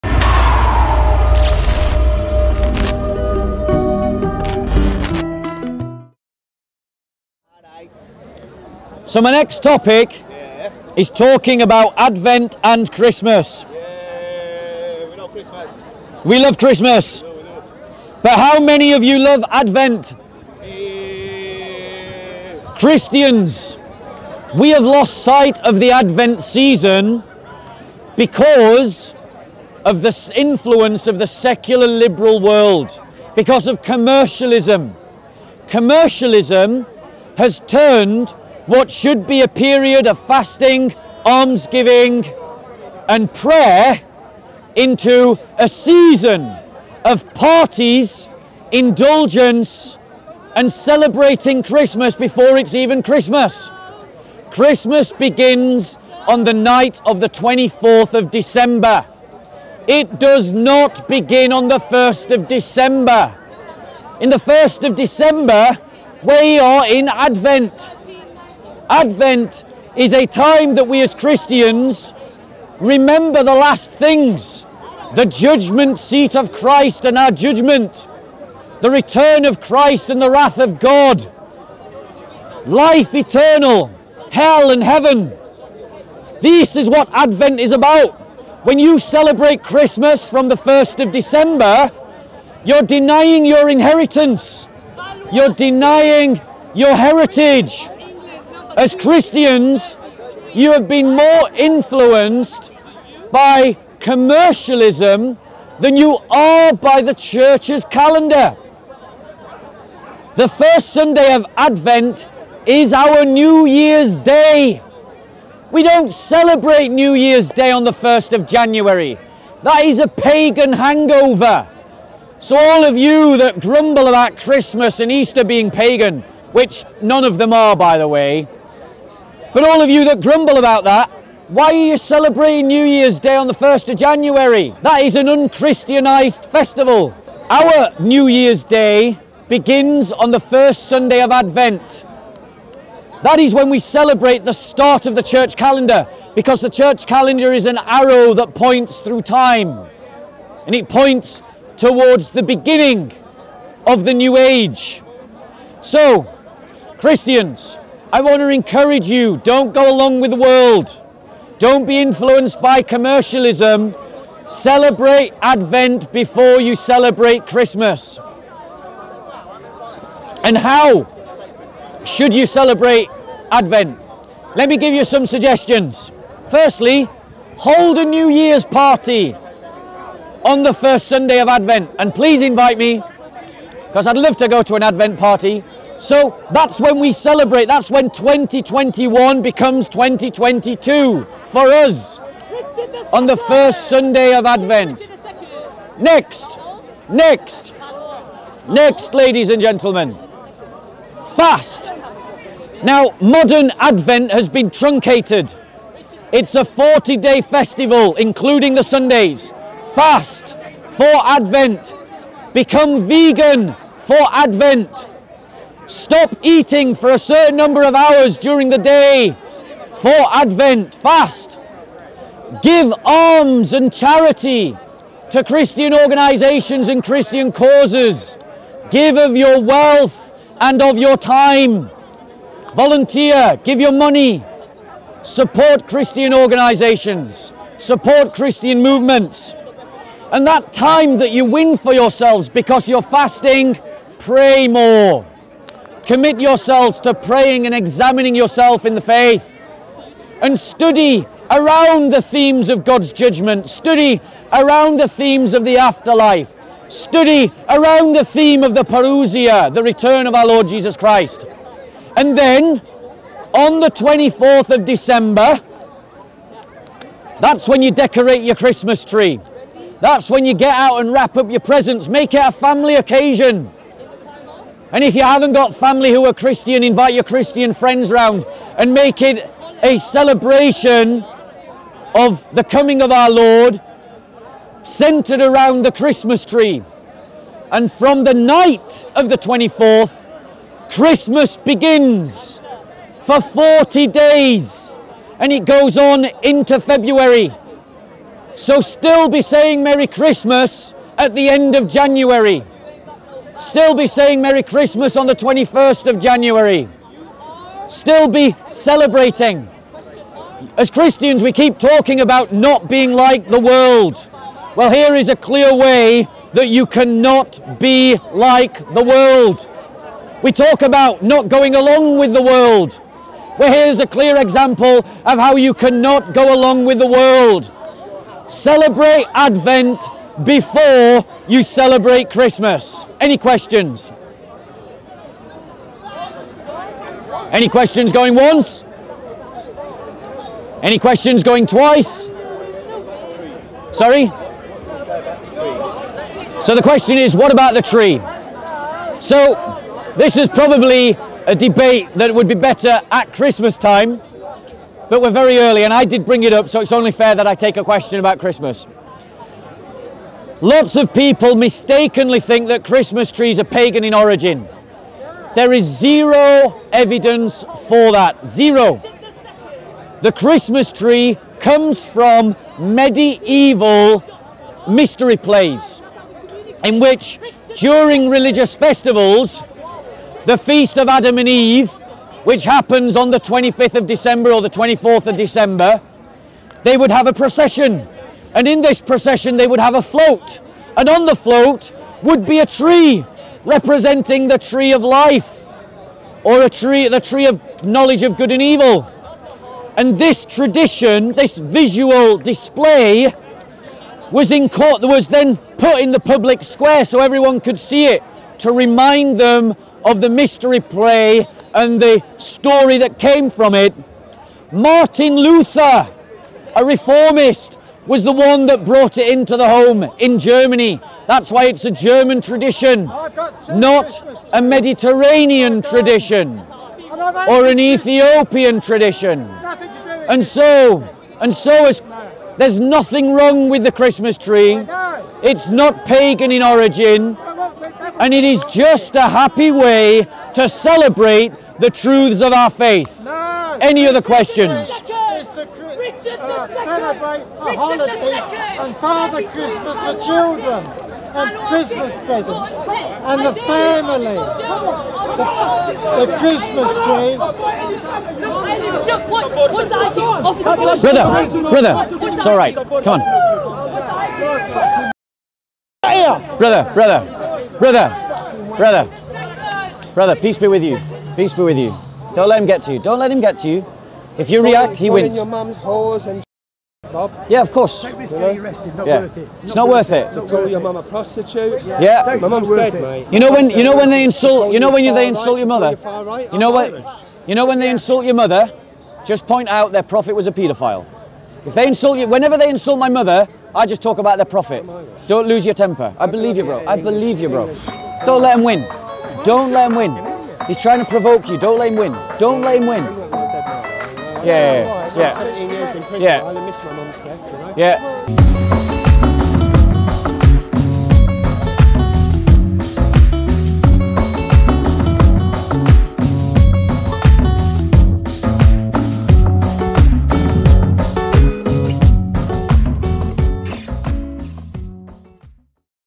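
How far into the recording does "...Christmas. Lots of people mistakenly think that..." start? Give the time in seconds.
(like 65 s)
358 s.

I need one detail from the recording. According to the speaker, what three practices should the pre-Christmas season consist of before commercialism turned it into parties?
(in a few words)
fasting, almsgiving, and prayer.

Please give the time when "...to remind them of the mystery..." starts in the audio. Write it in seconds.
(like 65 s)
408 s.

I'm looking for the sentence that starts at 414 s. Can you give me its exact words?
Martin Luther, a reformist, was the one that brought it into the home in Germany.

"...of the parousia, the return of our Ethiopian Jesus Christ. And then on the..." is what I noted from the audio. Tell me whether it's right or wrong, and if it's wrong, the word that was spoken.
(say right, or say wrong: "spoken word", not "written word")
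wrong: "Lord", not "Ethiopian".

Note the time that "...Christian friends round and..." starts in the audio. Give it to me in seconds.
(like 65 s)
277 s.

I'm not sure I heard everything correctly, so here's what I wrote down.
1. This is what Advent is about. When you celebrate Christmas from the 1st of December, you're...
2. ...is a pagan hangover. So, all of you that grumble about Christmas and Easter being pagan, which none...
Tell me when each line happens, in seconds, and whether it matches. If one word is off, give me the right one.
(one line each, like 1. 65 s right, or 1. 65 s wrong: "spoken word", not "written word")
1. 86 s right
2. 119 s right.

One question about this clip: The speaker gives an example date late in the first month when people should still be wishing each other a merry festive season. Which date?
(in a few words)
21st of January.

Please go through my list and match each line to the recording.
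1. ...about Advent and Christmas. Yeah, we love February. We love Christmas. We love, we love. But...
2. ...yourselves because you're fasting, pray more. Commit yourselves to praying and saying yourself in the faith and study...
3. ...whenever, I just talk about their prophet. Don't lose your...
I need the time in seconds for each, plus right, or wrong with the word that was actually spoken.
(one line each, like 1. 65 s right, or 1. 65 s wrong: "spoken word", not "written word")
1. 11 s wrong: "Christmas", not "February"
2. 241 s wrong: "examining", not "saying"
3. 493 s wrong: "mother", not "whenever".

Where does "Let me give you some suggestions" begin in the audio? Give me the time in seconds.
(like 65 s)
174 s.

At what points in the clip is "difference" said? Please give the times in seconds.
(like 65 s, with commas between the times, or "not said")
not said.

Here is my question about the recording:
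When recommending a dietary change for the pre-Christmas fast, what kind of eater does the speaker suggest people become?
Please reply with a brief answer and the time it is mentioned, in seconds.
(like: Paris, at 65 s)
vegan, at 213 s.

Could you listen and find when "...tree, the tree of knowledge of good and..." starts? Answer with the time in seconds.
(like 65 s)
396 s.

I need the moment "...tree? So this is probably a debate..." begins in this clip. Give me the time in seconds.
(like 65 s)
347 s.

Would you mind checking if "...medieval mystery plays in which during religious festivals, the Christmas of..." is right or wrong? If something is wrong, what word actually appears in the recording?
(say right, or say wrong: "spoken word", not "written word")
wrong: "Feast", not "Christmas".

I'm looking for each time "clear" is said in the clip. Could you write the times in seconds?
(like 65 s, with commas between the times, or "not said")
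315 s, 324 s.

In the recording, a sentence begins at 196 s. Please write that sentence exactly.
Next, next, next, ladies and gentlemen, fast.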